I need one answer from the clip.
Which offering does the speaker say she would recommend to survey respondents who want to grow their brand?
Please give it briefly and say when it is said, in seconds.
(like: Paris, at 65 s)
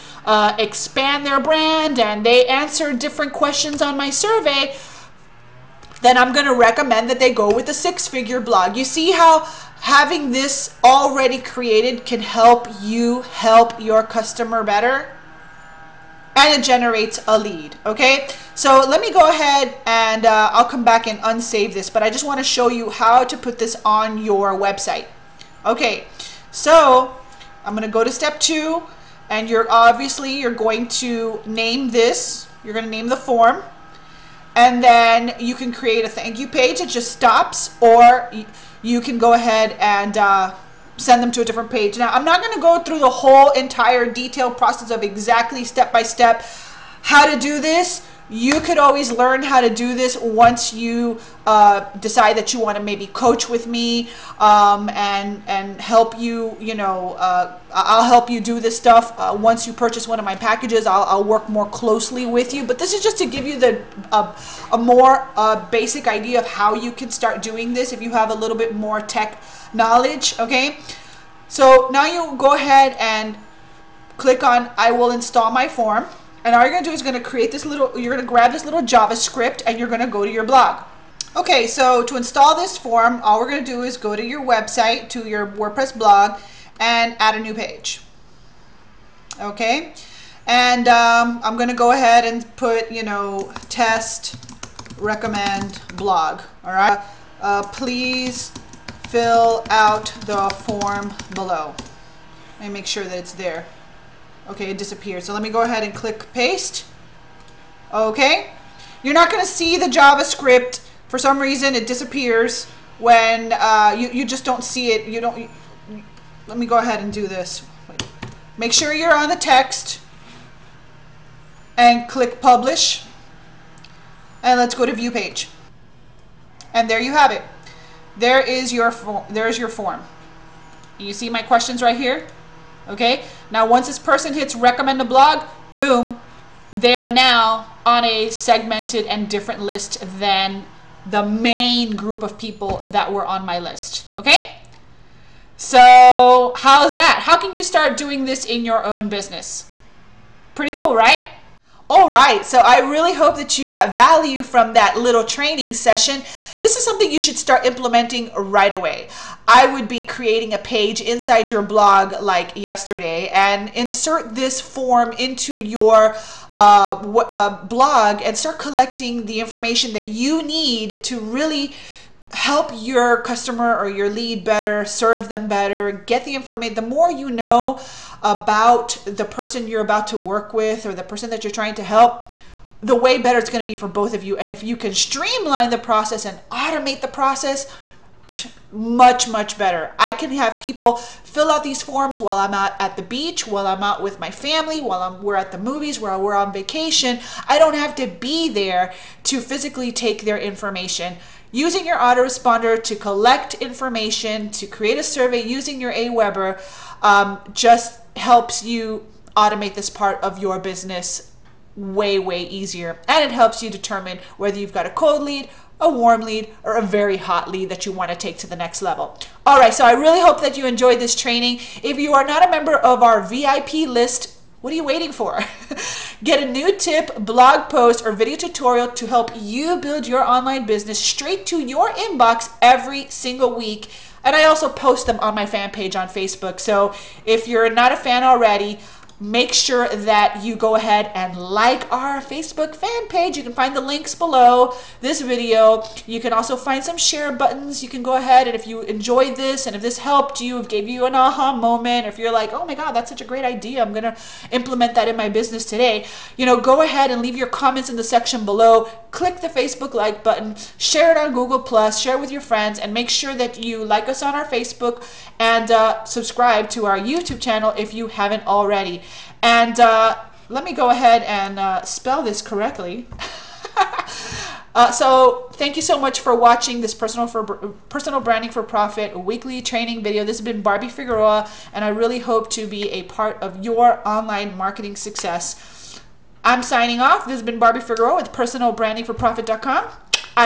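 six figure blog, at 7 s.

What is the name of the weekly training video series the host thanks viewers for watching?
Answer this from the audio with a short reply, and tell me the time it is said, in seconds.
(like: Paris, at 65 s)
personal branding for profit, at 277 s.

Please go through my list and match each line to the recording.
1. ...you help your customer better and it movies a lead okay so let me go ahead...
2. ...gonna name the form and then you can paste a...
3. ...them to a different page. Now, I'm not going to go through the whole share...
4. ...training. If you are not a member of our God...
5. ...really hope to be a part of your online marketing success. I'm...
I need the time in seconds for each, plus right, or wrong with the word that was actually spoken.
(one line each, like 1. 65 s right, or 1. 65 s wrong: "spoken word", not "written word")
1. 12 s wrong: "generates", not "movies"
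2. 32 s wrong: "create", not "paste"
3. 41 s wrong: "entire", not "share"
4. 221 s wrong: "VIP", not "God"
5. 281 s right.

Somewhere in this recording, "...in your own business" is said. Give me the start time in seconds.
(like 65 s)
148 s.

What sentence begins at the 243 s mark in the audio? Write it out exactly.
You can find the links below this video.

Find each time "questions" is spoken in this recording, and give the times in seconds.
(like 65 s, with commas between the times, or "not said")
3 s, 131 s.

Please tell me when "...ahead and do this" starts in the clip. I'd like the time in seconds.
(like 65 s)
116 s.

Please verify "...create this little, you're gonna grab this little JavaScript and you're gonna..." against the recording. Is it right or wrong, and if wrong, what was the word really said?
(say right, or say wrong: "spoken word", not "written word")
right.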